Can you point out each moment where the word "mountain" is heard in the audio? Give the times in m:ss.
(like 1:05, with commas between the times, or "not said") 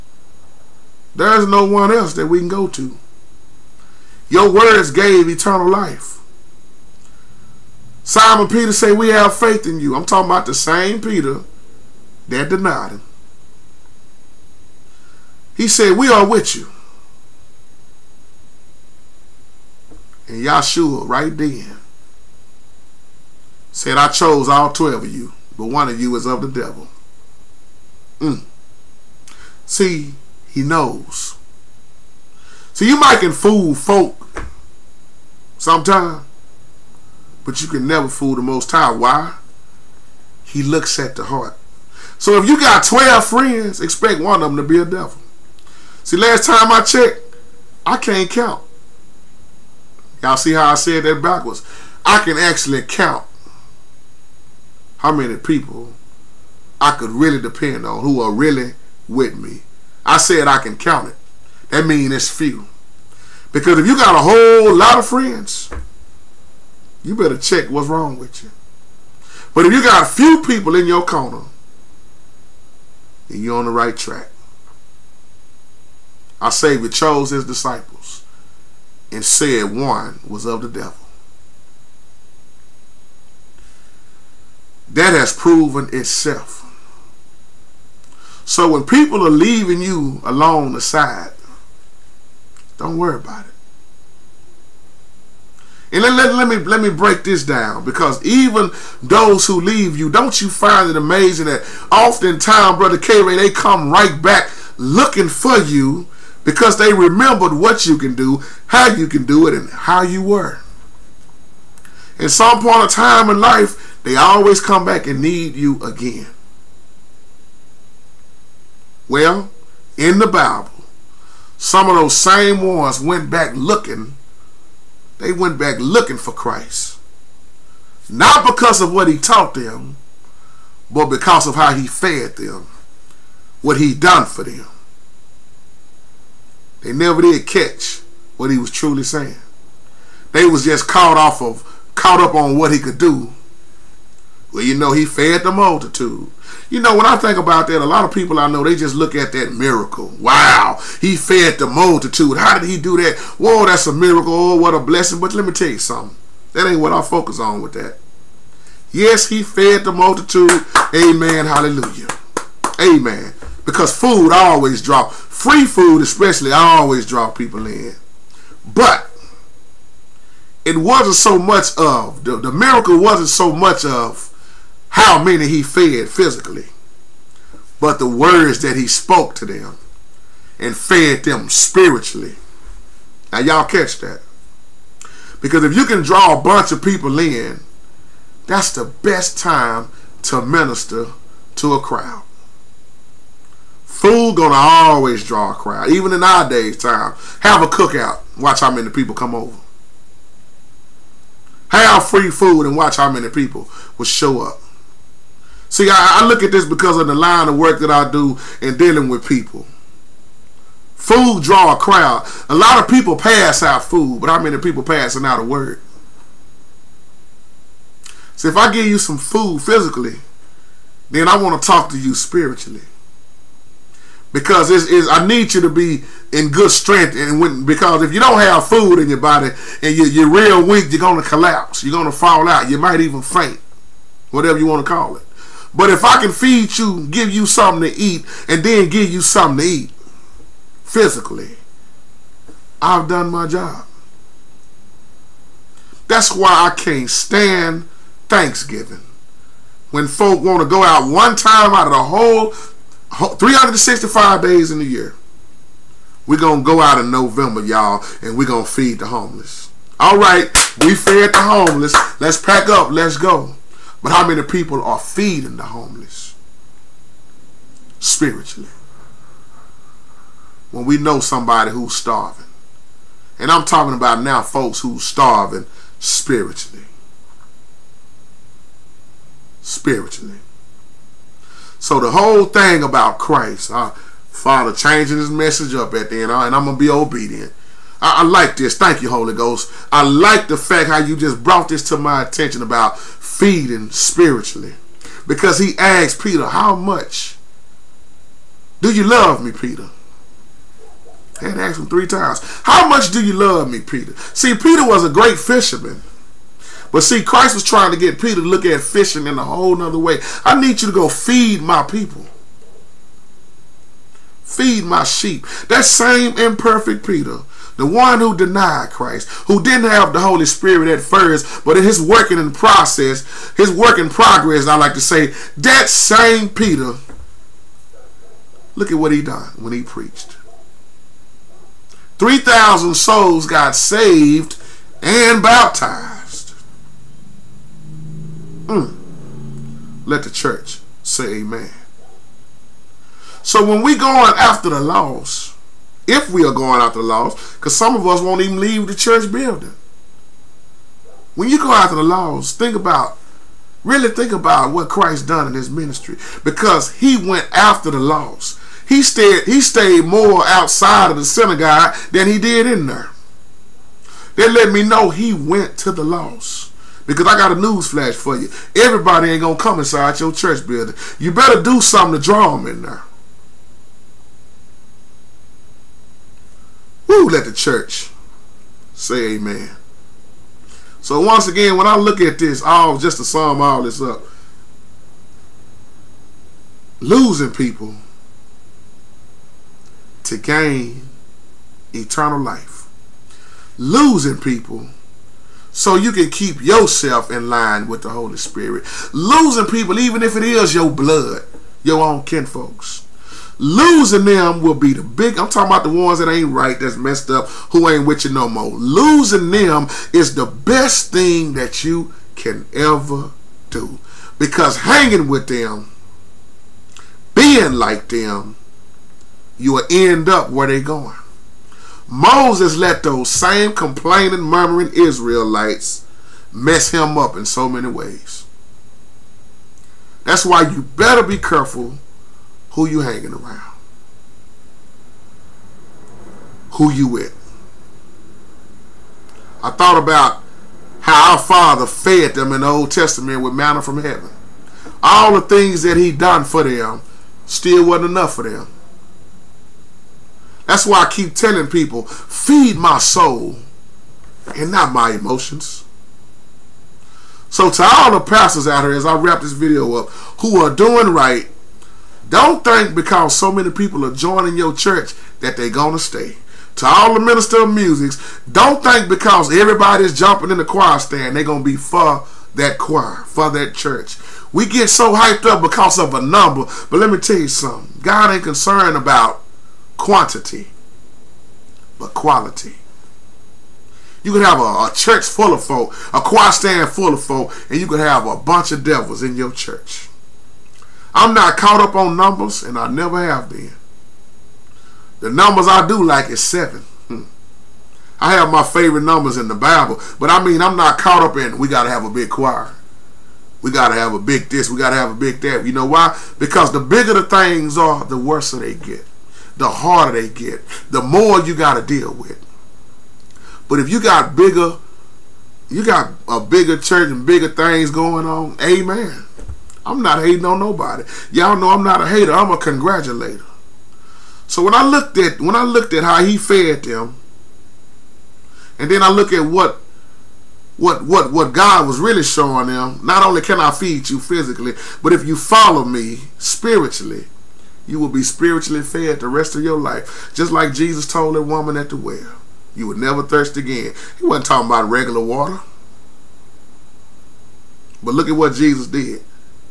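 not said.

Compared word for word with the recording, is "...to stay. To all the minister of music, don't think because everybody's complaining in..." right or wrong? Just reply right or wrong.
wrong.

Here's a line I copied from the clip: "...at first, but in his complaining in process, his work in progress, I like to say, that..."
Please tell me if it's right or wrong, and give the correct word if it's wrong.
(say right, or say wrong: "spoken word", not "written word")
wrong: "working", not "complaining".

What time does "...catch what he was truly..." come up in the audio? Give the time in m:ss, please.
2:17.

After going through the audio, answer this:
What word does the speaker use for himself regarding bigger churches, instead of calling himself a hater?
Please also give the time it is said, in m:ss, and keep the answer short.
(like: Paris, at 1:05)
congratulator, at 8:42.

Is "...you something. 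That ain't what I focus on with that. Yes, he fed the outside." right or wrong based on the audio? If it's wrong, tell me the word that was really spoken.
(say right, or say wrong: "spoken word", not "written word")
wrong: "multitude", not "outside".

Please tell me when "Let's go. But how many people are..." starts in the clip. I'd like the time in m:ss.
4:22.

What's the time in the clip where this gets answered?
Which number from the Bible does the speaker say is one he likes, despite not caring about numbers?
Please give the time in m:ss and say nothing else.
8:16.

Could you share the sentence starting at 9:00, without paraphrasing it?
Just like Jesus told the woman at the well, you would never thirst again.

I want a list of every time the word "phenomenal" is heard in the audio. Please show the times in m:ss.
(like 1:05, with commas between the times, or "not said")
not said.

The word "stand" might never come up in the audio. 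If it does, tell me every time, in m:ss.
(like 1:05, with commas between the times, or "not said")
4:07, 7:50, 8:06.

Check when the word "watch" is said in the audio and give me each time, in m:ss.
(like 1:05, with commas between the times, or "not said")
3:18, 3:22.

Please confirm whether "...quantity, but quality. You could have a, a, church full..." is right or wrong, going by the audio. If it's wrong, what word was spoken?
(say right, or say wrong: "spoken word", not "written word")
right.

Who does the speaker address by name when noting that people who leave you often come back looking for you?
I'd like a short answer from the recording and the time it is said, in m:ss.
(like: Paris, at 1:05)
Brother K Ray, at 1:42.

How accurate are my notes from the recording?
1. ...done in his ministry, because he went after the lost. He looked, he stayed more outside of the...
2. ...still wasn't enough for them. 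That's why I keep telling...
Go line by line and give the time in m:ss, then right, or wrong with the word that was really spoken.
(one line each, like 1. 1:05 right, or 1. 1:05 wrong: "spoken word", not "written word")
1. 5:55 wrong: "stayed", not "looked"
2. 7:27 right.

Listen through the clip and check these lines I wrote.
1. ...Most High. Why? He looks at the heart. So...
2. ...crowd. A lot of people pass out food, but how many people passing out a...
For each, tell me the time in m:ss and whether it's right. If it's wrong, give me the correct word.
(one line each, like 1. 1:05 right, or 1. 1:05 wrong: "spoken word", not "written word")
1. 0:38 right
2. 3:31 right.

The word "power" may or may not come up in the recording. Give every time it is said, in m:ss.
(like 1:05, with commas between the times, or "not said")
not said.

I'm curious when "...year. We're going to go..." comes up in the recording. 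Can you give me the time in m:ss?
4:14.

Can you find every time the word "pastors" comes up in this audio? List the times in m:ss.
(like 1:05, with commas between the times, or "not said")
7:38.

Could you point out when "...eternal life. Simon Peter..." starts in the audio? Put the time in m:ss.
0:05.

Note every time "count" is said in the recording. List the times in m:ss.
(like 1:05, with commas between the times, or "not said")
0:48, 0:52, 1:00.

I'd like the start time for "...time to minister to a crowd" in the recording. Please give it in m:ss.
3:09.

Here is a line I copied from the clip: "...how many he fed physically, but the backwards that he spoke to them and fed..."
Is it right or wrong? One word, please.
wrong.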